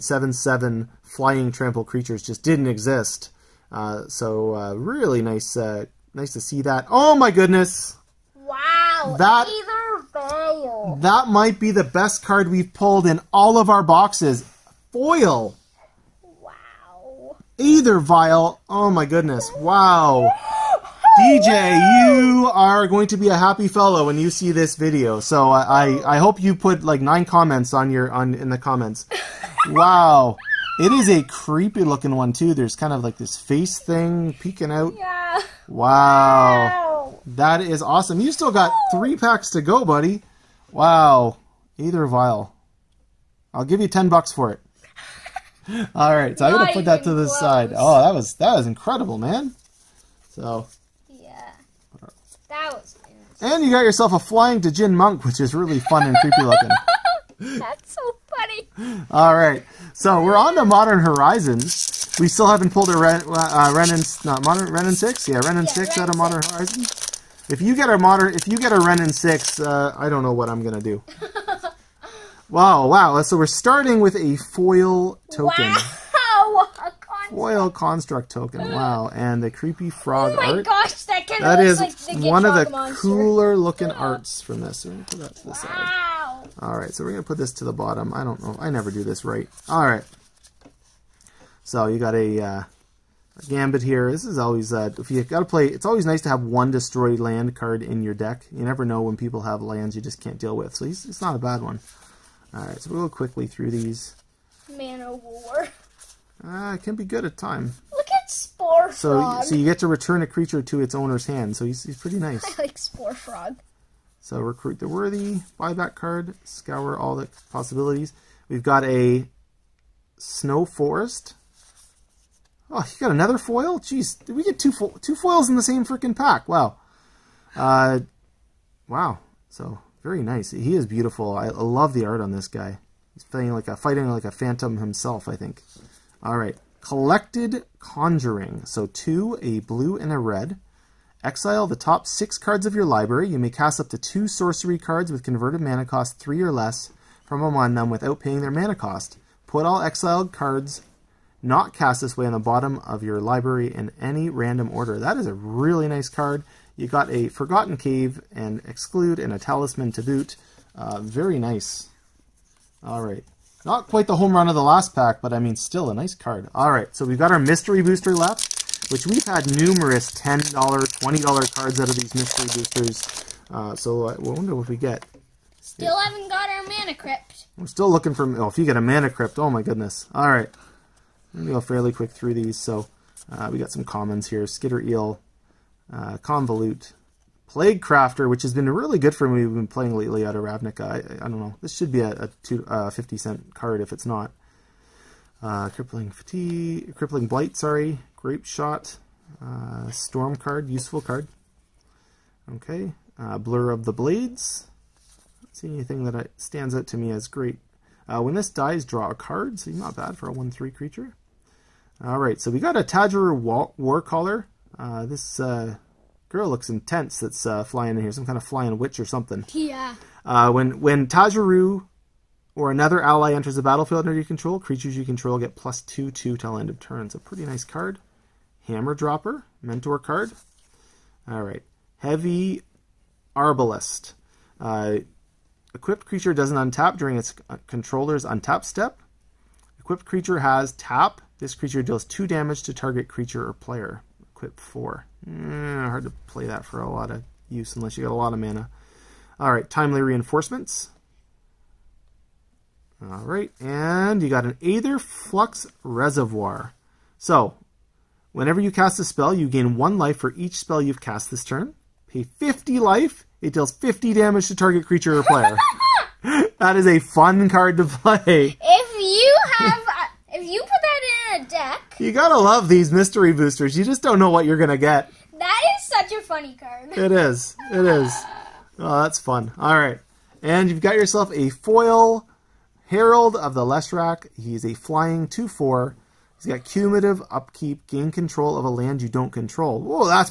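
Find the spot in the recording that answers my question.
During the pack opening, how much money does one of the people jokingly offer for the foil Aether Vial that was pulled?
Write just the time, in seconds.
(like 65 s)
43 s.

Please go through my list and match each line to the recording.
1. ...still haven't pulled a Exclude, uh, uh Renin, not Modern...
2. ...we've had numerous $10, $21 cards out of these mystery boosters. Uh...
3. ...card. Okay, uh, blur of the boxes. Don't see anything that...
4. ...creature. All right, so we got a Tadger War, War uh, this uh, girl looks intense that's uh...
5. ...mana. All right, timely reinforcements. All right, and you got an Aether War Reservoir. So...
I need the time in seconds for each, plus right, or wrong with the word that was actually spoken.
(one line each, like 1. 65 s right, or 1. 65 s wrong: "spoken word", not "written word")
1. 62 s wrong: "Ren", not "Exclude"
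2. 169 s wrong: "20", not "21"
3. 201 s wrong: "blades", not "boxes"
4. 210 s right
5. 248 s wrong: "Flux", not "War".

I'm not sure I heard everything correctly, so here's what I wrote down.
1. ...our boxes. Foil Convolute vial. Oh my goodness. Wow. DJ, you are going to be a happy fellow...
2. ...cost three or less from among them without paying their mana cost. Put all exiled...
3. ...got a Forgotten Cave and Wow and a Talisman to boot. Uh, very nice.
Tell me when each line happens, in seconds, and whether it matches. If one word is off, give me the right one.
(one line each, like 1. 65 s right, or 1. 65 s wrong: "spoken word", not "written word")
1. 13 s wrong: "Aether", not "Convolute"
2. 145 s right
3. 156 s wrong: "Exclude", not "Wow".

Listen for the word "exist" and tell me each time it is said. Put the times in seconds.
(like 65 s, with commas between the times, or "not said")
2 s.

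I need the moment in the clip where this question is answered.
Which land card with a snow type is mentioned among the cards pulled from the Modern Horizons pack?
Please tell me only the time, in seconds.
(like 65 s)
120 s.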